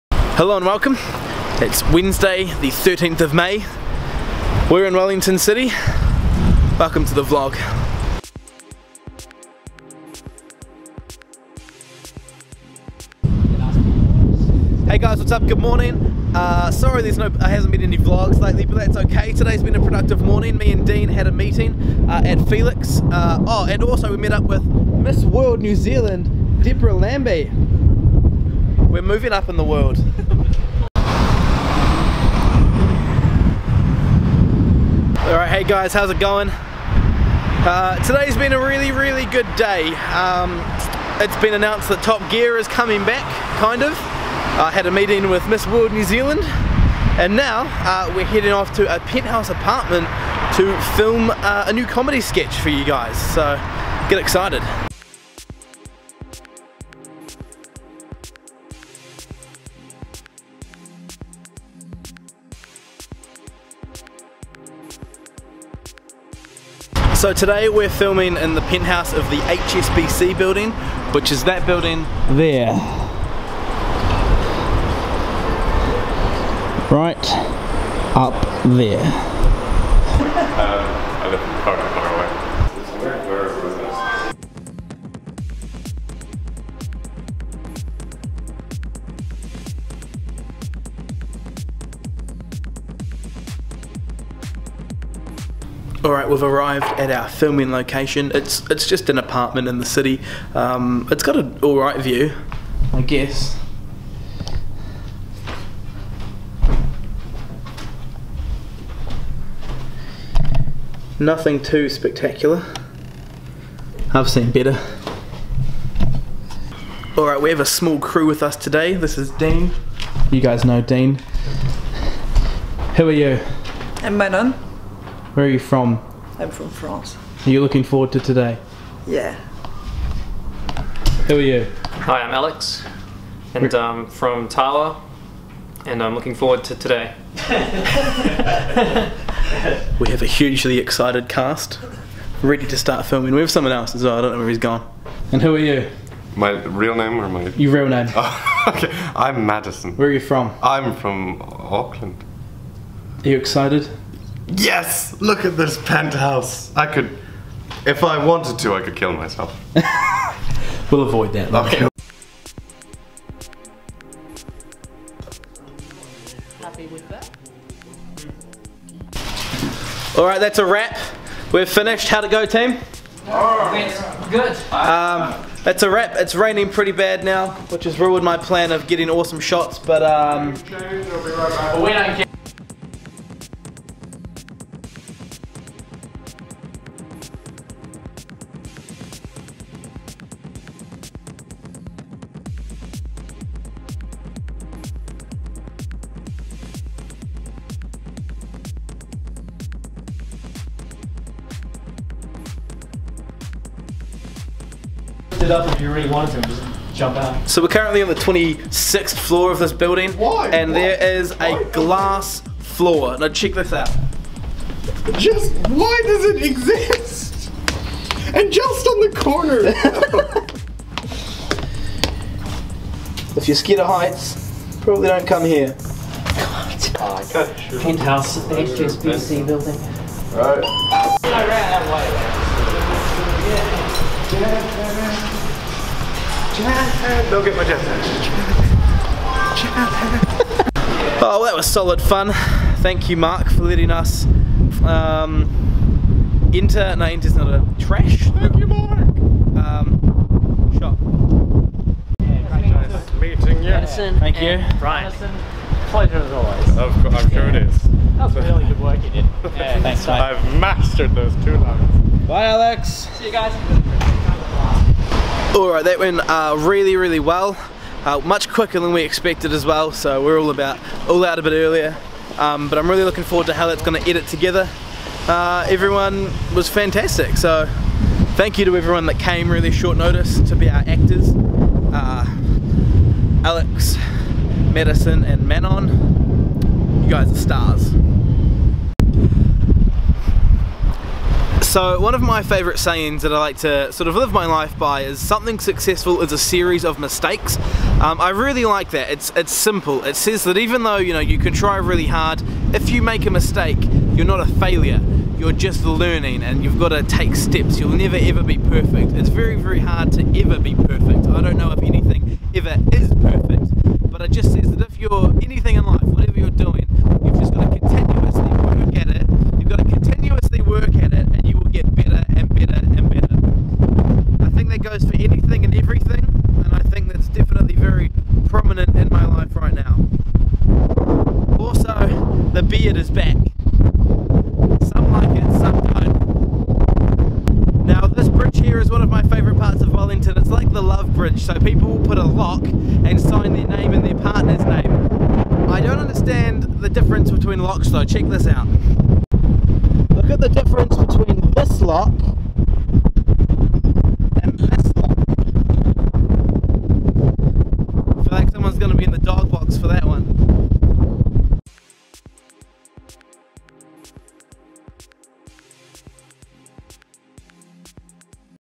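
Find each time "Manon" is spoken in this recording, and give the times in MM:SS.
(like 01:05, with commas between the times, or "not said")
02:04, 04:45.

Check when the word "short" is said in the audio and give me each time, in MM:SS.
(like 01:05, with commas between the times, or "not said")
04:39.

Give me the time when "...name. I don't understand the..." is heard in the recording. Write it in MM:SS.
05:44.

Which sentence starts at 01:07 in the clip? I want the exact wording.
So today we're filming in the penthouse of the HSBC building, which is that building there.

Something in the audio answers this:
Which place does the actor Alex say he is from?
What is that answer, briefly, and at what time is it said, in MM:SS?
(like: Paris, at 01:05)
Tawa, at 02:14.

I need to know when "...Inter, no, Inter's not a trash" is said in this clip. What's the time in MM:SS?
04:06.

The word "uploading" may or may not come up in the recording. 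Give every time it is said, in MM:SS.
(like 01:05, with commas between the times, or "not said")
not said.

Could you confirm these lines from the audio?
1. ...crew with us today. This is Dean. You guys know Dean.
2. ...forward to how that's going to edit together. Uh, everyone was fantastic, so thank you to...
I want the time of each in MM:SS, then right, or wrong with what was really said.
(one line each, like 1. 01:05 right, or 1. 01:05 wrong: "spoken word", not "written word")
1. 01:57 right
2. 04:33 right.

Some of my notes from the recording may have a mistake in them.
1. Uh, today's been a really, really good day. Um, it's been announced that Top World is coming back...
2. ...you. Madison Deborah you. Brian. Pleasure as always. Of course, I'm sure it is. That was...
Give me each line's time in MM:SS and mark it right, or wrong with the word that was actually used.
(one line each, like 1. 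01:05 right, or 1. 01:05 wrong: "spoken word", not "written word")
1. 00:37 wrong: "Gear", not "World"
2. 04:13 wrong: "Thank", not "Deborah".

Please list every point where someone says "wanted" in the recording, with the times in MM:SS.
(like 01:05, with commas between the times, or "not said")
02:38, 03:26.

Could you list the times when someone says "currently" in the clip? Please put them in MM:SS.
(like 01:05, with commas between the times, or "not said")
03:27.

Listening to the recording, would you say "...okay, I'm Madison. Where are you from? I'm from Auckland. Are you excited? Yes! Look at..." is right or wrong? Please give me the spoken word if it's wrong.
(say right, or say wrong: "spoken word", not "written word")
right.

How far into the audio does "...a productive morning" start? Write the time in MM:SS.
00:19.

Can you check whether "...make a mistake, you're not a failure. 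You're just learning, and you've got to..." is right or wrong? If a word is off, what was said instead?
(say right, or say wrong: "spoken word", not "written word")
right.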